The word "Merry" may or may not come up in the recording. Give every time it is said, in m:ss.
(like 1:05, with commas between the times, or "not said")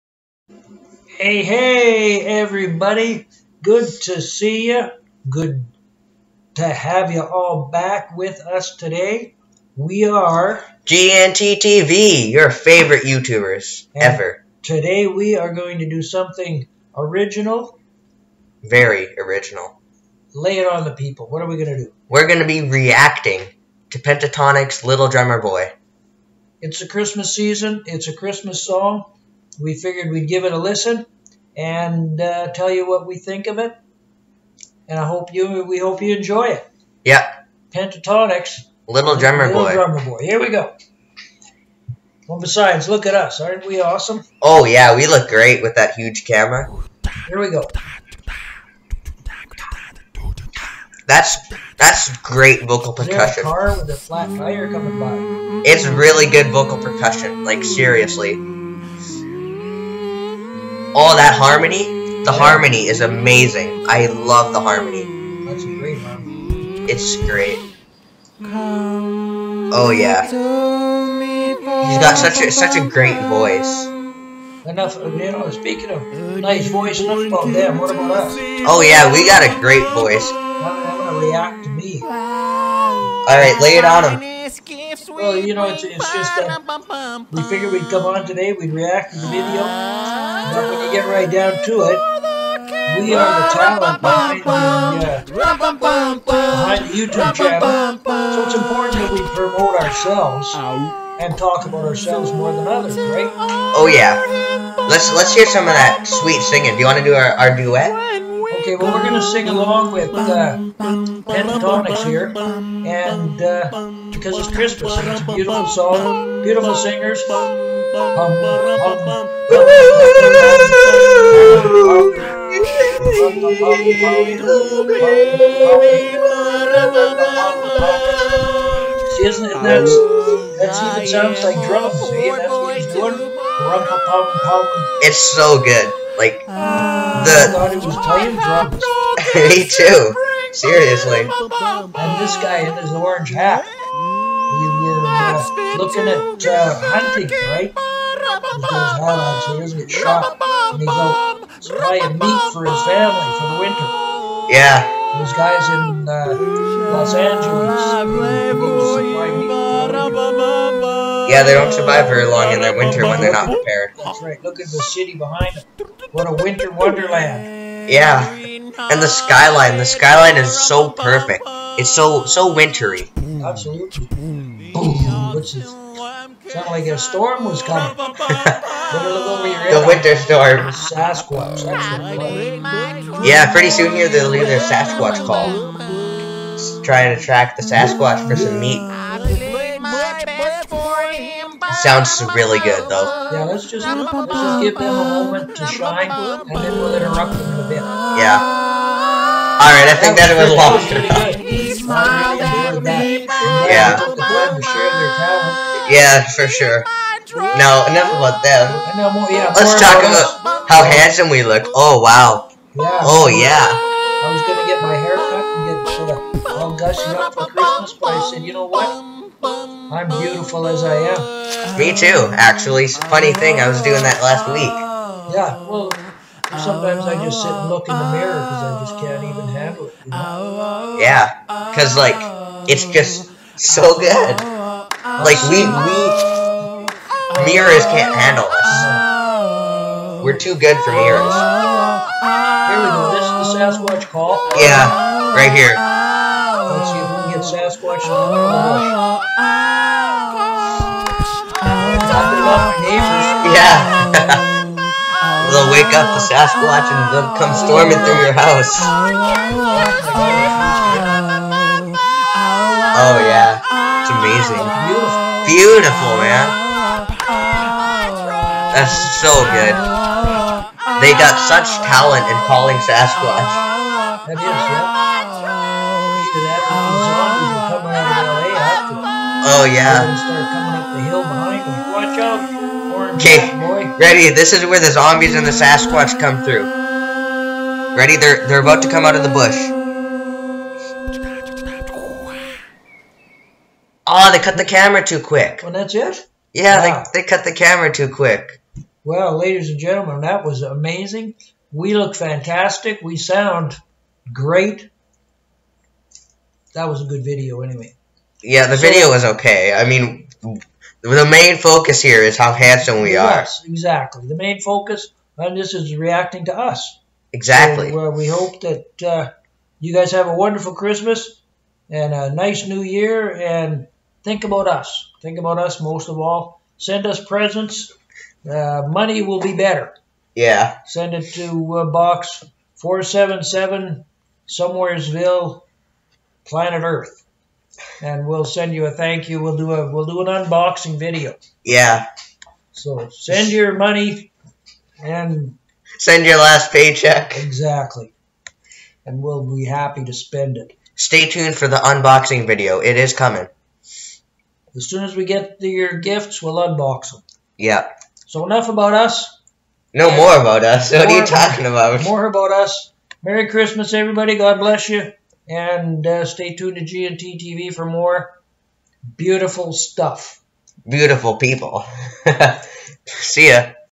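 6:03.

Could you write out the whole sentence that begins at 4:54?
Oh, they cut the camera too quick.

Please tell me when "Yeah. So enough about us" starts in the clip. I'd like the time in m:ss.
5:57.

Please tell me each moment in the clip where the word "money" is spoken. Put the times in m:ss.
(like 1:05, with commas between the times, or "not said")
5:28, 5:43.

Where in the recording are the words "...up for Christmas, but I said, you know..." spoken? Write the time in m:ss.
3:37.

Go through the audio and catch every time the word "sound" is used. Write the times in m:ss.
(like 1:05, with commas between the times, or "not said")
2:11, 2:55, 3:11, 5:03.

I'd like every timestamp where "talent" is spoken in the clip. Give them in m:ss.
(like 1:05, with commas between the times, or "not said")
1:33, 4:31.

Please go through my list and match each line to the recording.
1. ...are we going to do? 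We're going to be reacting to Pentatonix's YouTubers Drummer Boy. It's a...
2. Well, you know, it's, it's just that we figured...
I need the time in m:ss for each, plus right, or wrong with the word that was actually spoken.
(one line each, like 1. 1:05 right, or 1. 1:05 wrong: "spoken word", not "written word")
1. 0:21 wrong: "Little", not "YouTubers"
2. 1:25 right.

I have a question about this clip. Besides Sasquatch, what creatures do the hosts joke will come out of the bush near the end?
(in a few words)
Zombies.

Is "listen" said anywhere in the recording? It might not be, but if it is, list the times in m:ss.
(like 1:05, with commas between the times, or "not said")
0:30.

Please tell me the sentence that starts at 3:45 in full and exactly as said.
Yeah, well, sometimes I just sit and look in the mirror because I just can't even handle it.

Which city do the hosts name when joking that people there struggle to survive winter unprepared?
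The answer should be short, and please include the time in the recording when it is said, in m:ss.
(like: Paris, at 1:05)
Los Angeles, at 2:36.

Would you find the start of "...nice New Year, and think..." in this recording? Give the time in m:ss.
5:22.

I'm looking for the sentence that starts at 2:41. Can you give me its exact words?
Yeah, they don't survive very long in their winter when they're not prepared.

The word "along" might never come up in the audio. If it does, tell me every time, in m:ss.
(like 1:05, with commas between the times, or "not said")
1:49.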